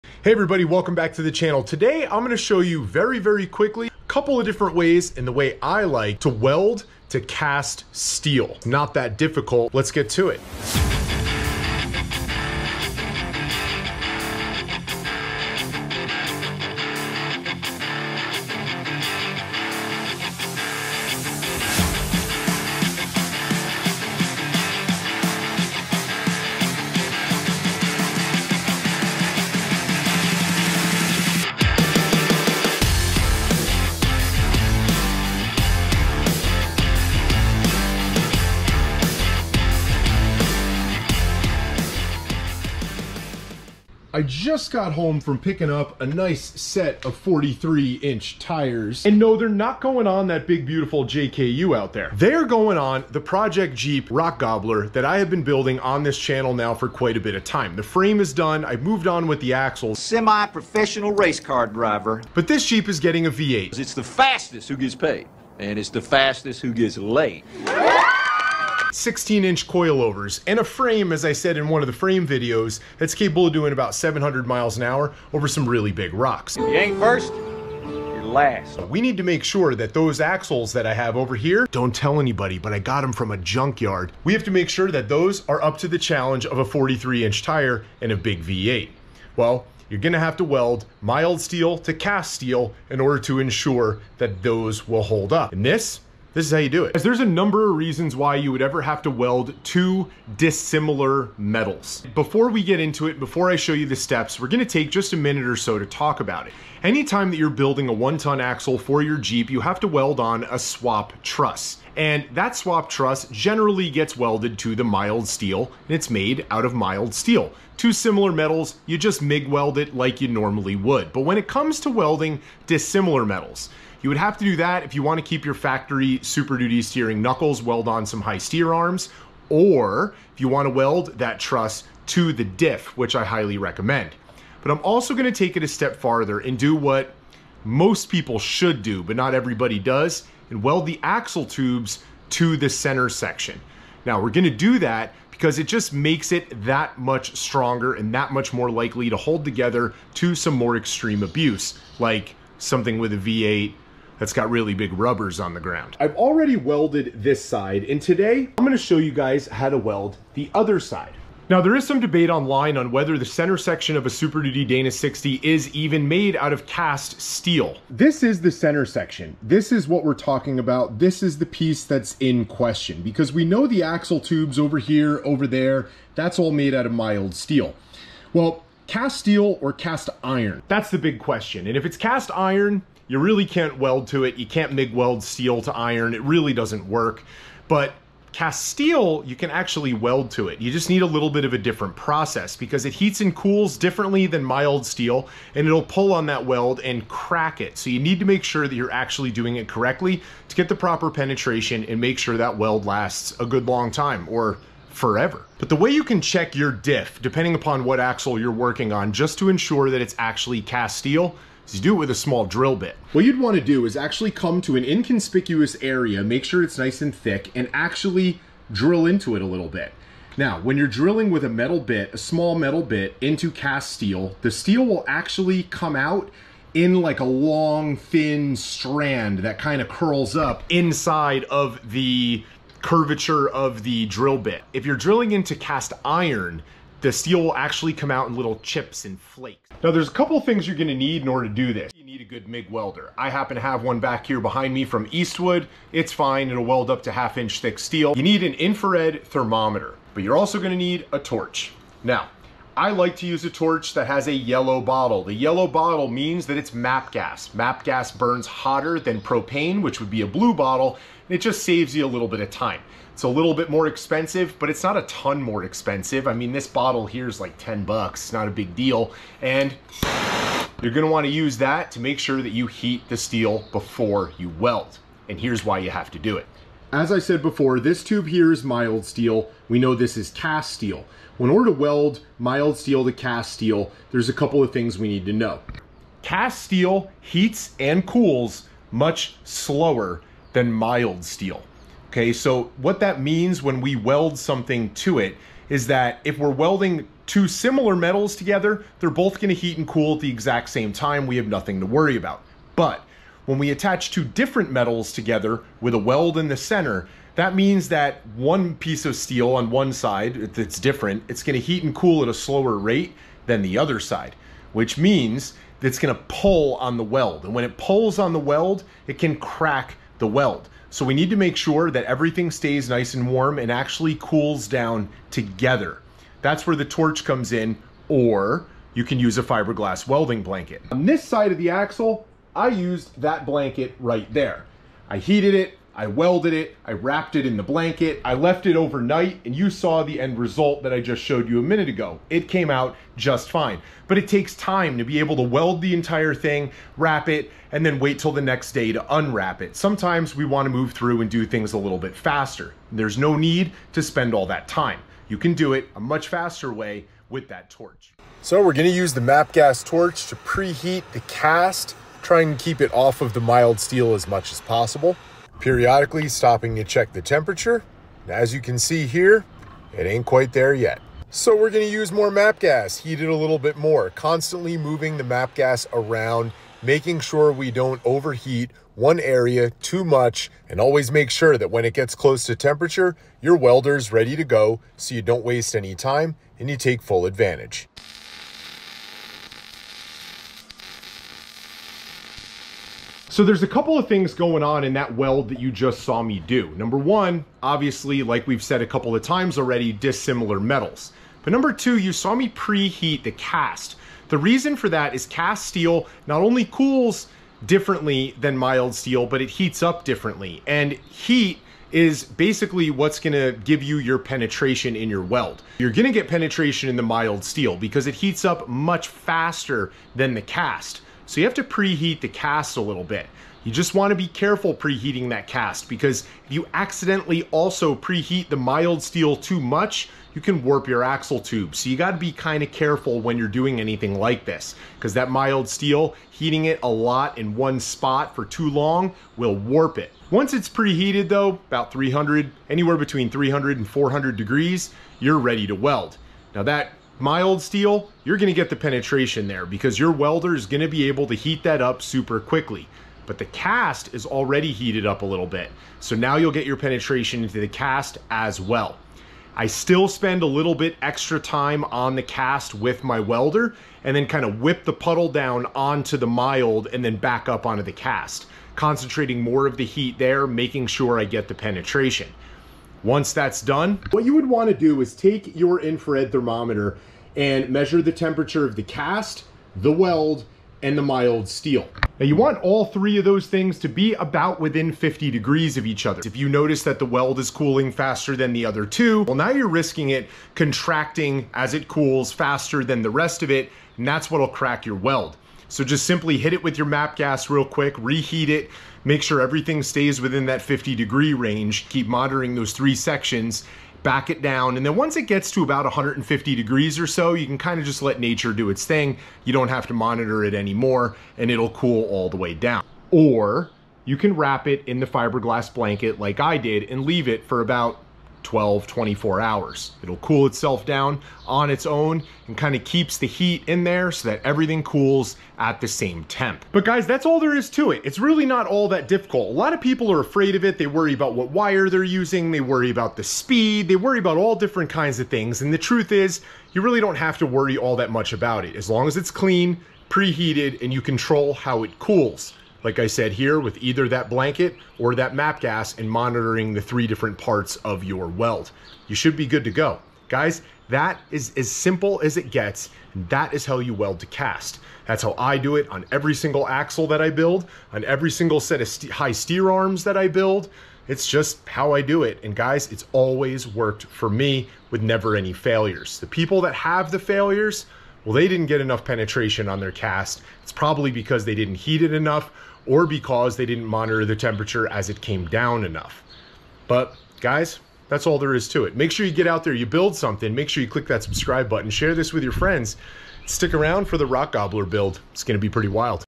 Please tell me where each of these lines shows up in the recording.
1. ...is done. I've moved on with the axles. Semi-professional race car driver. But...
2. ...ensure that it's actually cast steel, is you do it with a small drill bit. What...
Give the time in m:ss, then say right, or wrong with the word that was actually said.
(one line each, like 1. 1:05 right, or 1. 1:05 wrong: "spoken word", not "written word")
1. 0:58 right
2. 3:29 right.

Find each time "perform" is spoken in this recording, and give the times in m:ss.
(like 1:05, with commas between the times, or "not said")
not said.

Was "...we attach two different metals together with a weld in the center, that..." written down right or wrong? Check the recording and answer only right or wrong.
right.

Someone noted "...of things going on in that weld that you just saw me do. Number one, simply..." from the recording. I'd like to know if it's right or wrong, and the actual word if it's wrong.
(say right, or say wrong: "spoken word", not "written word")
wrong: "obviously", not "simply".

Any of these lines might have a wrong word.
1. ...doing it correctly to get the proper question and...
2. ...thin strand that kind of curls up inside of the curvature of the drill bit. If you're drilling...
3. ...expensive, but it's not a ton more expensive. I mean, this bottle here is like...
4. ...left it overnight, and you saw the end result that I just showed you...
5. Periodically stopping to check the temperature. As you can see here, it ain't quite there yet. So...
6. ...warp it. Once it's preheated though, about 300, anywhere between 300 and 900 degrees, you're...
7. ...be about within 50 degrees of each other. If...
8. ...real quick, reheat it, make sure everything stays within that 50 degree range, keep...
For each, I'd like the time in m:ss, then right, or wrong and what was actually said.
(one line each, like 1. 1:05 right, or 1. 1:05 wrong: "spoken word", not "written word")
1. 3:19 wrong: "penetration", not "question"
2. 3:47 right
3. 4:23 right
4. 5:38 right
5. 6:05 right
6. 7:19 wrong: "400", not "900"
7. 8:03 right
8. 8:17 right.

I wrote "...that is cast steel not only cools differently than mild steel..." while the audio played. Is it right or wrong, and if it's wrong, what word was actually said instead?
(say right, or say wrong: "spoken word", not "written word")
right.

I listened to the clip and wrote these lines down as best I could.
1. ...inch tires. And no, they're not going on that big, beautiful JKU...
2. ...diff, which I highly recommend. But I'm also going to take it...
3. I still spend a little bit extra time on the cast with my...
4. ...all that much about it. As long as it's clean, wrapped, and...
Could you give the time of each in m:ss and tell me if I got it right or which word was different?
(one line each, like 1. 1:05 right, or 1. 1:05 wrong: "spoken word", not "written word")
1. 0:48 right
2. 2:12 right
3. 7:39 right
4. 8:57 wrong: "preheated", not "wrapped".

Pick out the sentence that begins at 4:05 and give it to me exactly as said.
It's fine, it'll weld up to half inch thick steel.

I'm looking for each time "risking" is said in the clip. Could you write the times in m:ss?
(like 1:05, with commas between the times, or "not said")
8:09.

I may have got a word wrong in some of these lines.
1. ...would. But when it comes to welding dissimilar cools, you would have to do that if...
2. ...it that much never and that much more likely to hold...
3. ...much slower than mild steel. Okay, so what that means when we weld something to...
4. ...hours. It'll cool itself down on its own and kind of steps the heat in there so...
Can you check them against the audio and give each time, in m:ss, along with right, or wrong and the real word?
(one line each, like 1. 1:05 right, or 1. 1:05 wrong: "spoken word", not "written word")
1. 2:00 wrong: "metals", not "cools"
2. 2:26 wrong: "stronger", not "never"
3. 4:48 right
4. 8:39 wrong: "keeps", not "steps".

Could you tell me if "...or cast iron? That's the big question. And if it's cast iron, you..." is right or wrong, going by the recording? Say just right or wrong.
right.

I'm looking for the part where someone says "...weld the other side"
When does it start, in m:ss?
2:39.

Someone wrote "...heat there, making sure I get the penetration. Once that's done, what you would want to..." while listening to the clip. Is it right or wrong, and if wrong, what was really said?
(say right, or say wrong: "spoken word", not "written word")
right.